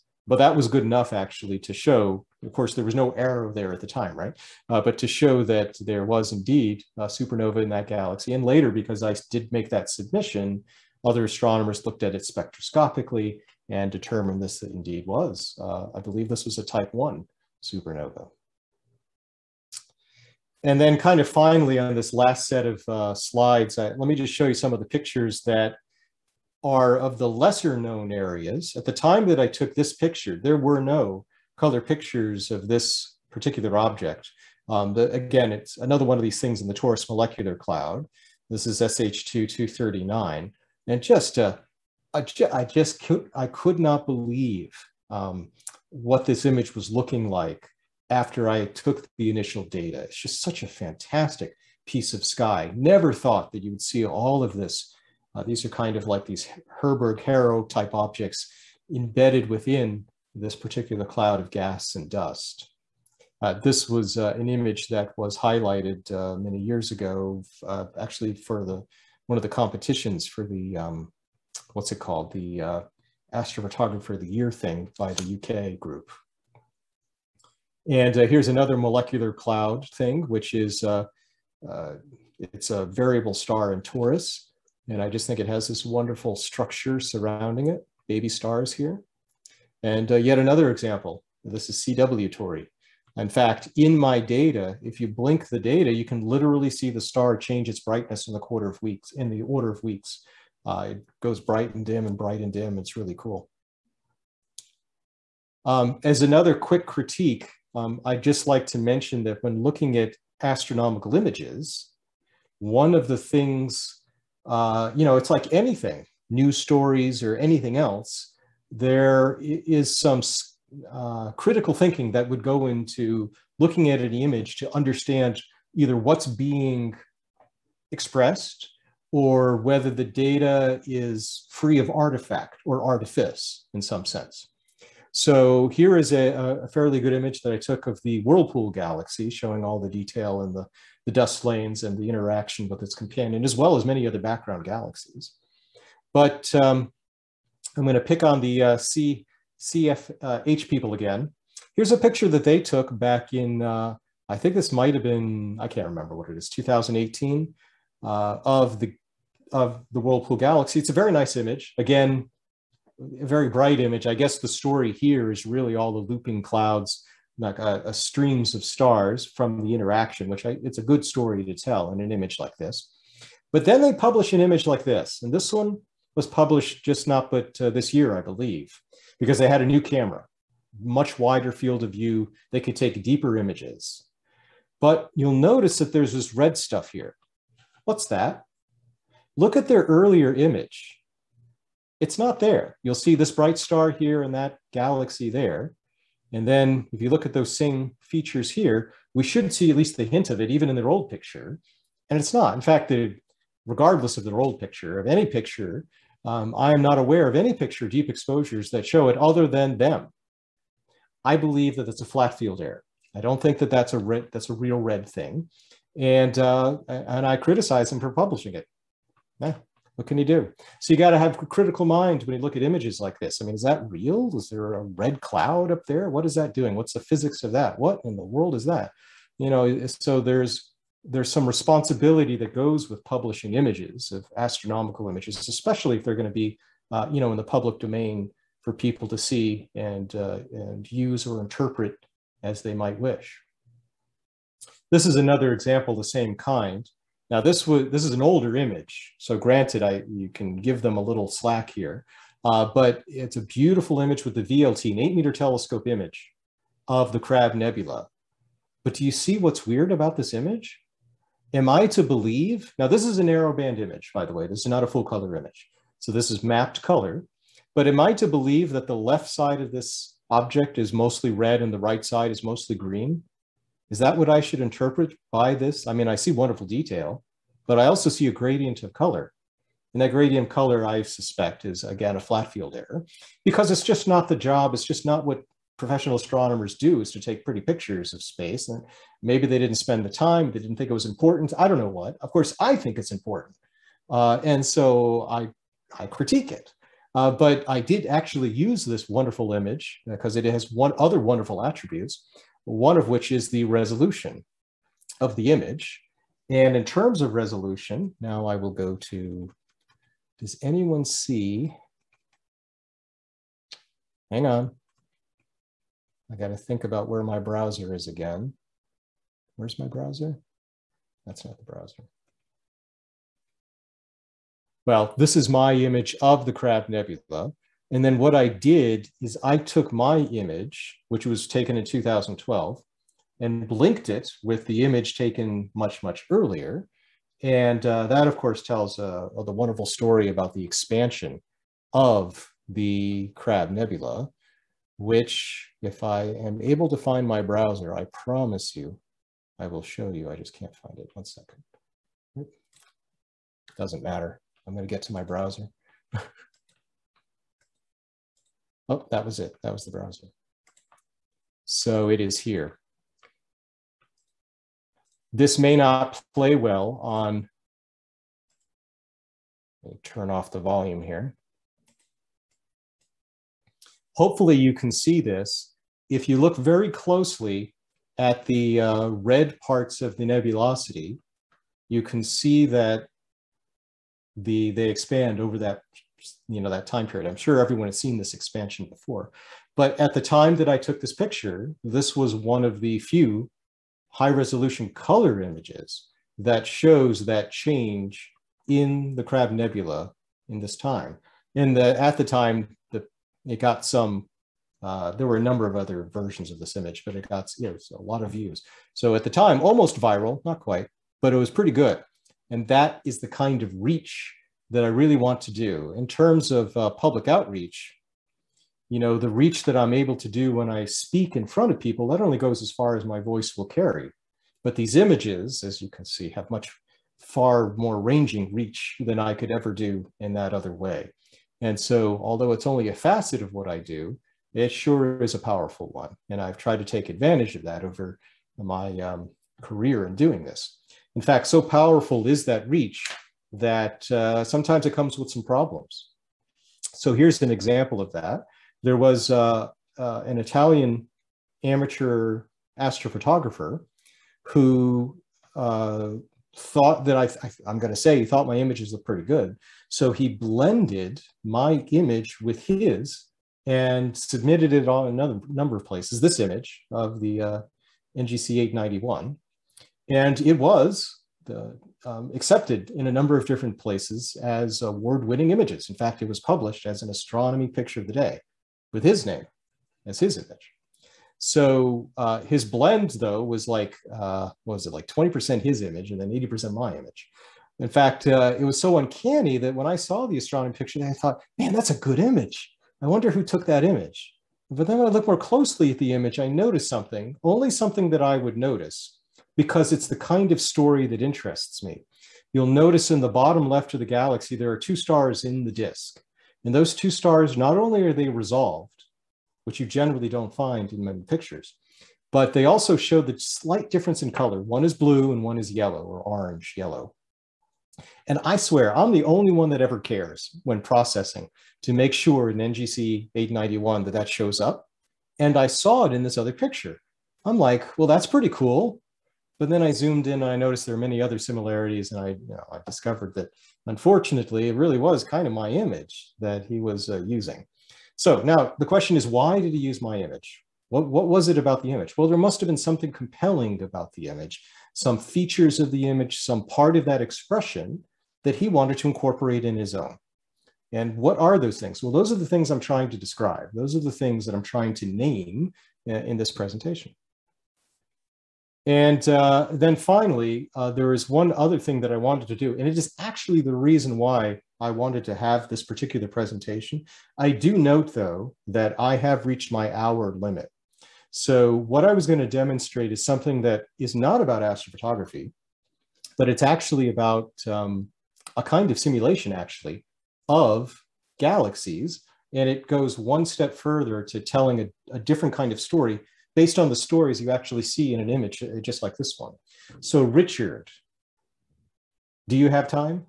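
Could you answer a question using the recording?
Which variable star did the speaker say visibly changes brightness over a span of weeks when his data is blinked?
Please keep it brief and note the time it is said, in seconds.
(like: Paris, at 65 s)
CW Tauri, at 91 s.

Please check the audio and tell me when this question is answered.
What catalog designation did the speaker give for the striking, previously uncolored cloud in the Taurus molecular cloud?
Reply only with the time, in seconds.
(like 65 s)
38 s.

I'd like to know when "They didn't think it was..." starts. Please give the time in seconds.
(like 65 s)
290 s.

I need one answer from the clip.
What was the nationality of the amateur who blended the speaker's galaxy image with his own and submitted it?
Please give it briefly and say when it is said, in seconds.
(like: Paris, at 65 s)
Italian, at 450 s.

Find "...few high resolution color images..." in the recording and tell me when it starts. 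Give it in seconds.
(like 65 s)
392 s.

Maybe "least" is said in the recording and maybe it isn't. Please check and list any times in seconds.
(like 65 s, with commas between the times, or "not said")
199 s.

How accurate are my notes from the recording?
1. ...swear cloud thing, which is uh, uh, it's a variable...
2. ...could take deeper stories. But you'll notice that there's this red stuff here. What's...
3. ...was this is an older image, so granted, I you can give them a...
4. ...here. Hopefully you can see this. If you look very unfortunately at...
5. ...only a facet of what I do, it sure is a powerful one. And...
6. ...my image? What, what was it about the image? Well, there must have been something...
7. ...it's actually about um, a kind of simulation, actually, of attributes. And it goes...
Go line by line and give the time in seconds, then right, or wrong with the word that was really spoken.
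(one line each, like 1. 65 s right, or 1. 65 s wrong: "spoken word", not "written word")
1. 78 s wrong: "molecular", not "swear"
2. 182 s wrong: "images", not "stories"
3. 247 s right
4. 371 s wrong: "closely", not "unfortunately"
5. 432 s right
6. 540 s right
7. 576 s wrong: "galaxies", not "attributes".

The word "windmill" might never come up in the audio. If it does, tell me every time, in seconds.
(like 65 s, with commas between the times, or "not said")
not said.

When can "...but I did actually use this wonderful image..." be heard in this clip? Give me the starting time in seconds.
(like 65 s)
297 s.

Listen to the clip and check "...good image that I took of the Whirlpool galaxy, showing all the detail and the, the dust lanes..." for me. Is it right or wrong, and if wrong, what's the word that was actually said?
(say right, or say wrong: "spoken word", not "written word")
right.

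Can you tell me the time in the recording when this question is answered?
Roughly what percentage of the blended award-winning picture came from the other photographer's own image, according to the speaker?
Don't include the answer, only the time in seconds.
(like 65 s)
485 s.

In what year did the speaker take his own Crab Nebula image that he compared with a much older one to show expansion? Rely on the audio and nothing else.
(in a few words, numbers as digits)
2012.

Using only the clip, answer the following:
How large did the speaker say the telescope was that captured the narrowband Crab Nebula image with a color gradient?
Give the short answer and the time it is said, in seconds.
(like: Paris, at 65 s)
8 meter, at 254 s.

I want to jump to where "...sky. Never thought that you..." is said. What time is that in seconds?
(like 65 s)
52 s.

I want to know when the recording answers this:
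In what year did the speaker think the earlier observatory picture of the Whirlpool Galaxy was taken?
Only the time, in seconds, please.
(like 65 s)
156 s.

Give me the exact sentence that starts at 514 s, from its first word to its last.
One is blue and one is yellow or orange yellow.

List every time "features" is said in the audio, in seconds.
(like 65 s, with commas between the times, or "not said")
198 s, 545 s.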